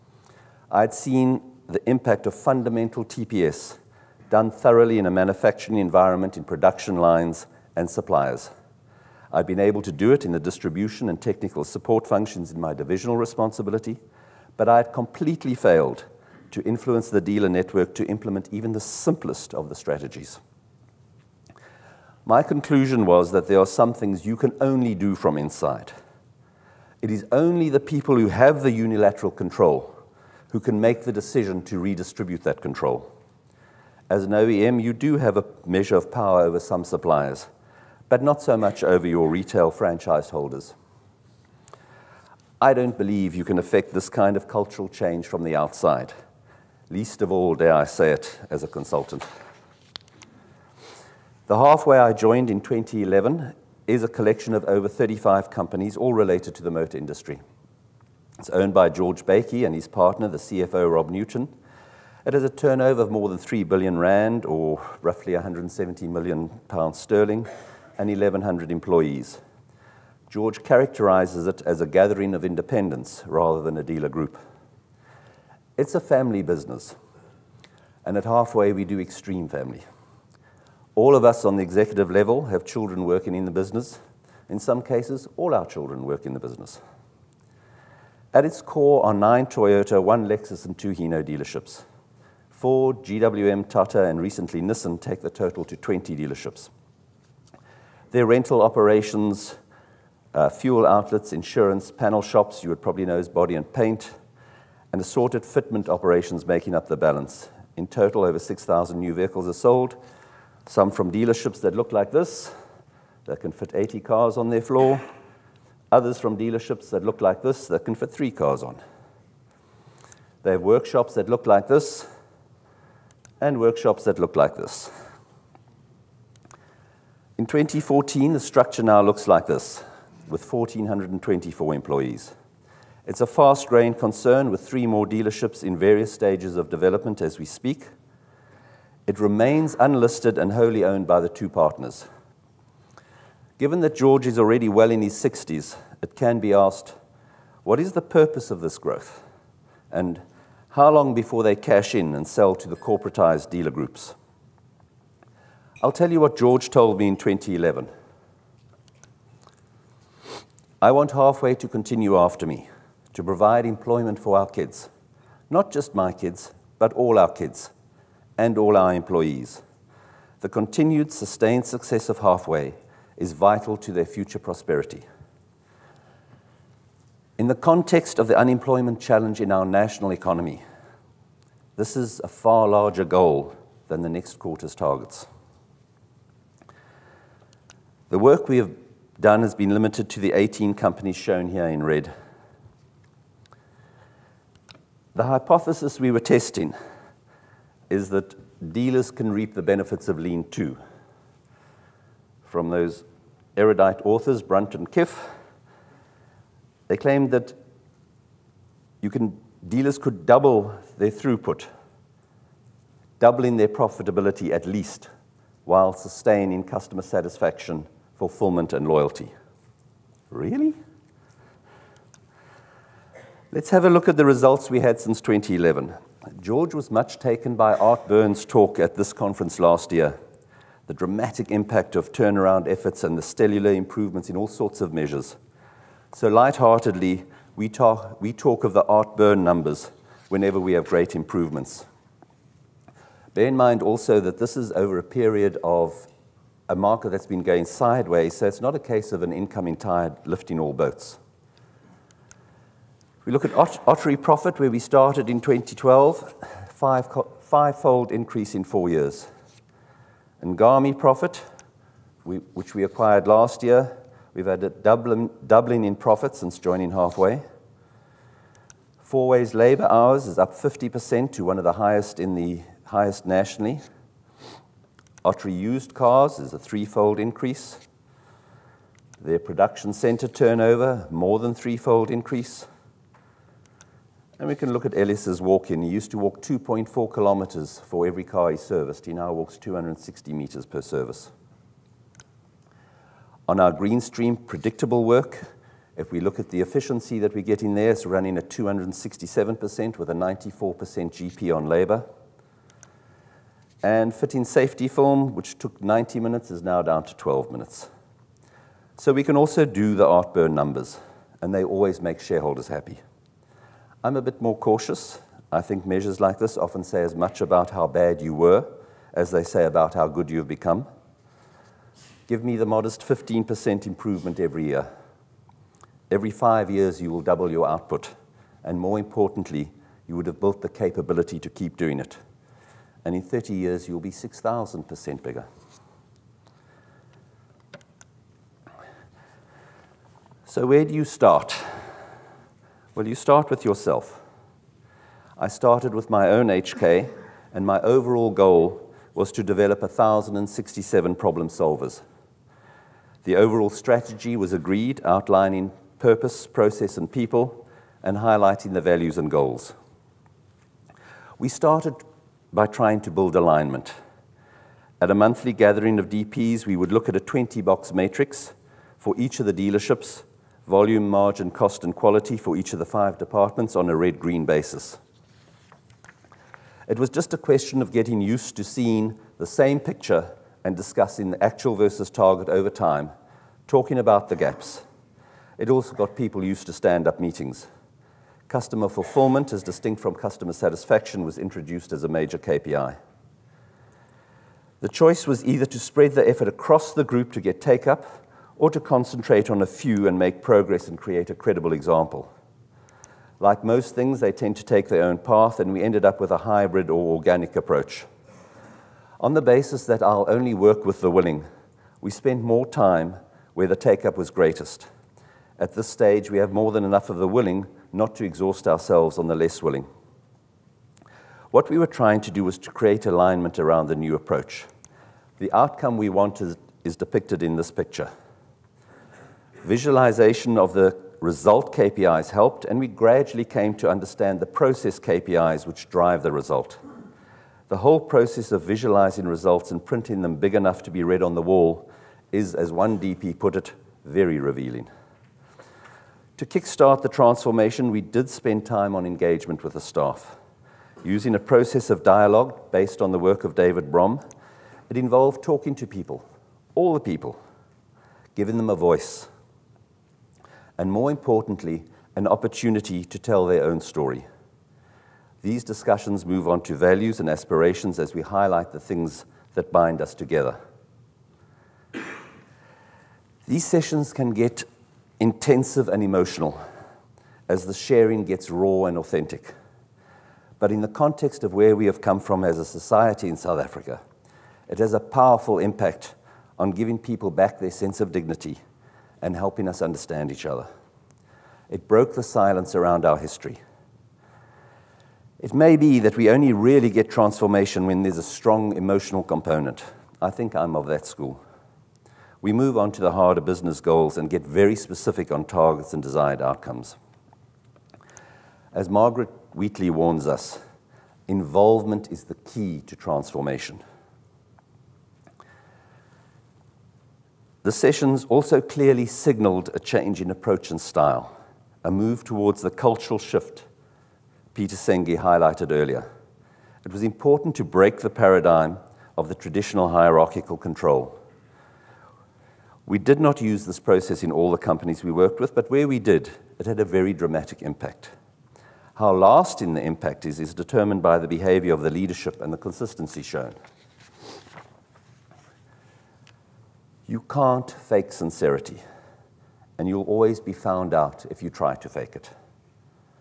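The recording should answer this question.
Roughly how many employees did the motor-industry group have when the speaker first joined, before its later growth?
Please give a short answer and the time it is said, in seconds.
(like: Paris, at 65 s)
1,100, at 68 s.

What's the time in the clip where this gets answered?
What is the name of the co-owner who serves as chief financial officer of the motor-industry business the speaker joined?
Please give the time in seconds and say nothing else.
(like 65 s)
60 s.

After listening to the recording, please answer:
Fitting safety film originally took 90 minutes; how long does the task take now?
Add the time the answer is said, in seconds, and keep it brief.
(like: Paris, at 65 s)
12 minutes, at 307 s.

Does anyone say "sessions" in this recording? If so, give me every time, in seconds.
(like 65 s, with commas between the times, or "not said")
473 s, 517 s.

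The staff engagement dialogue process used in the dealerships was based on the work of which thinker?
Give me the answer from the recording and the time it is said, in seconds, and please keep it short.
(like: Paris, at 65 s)
David Bohm, at 453 s.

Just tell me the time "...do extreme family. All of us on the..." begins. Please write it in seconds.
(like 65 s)
78 s.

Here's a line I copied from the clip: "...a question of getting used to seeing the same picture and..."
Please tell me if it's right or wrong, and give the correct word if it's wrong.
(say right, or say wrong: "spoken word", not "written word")
right.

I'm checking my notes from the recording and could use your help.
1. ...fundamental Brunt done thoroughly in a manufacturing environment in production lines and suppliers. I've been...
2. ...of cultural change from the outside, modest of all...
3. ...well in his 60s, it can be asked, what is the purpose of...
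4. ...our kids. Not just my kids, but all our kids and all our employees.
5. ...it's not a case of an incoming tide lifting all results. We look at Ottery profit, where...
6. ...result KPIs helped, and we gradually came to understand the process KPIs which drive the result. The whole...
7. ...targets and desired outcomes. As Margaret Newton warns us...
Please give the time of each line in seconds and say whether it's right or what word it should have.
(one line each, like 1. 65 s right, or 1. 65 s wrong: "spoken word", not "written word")
1. 2 s wrong: "TPS", not "Brunt"
2. 44 s wrong: "least", not "modest"
3. 144 s right
4. 164 s right
5. 248 s wrong: "boats", not "results"
6. 431 s right
7. 505 s wrong: "Wheatley", not "Newton".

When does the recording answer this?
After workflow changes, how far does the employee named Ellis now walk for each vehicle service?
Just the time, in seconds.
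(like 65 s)
289 s.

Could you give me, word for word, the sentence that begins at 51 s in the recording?
The Halfway I joined in 2011 is a collection of over 35 companies, all related to the motor industry.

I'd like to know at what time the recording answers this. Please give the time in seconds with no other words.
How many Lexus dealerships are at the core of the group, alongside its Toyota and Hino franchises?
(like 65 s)
90 s.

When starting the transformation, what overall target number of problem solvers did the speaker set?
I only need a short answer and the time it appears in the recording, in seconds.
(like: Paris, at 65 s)
1,067, at 349 s.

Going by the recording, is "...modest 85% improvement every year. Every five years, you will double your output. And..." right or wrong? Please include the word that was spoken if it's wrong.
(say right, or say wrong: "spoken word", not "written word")
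wrong: "15", not "85".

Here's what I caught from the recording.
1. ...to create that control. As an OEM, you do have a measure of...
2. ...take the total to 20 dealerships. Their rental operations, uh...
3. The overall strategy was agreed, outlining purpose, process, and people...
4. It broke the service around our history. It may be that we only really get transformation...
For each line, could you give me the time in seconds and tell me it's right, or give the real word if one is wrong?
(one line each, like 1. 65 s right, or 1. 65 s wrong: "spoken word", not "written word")
1. 31 s wrong: "redistribute", not "create"
2. 94 s right
3. 353 s right
4. 491 s wrong: "silence", not "service".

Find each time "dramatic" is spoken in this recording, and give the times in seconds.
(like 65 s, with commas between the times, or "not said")
230 s, 537 s.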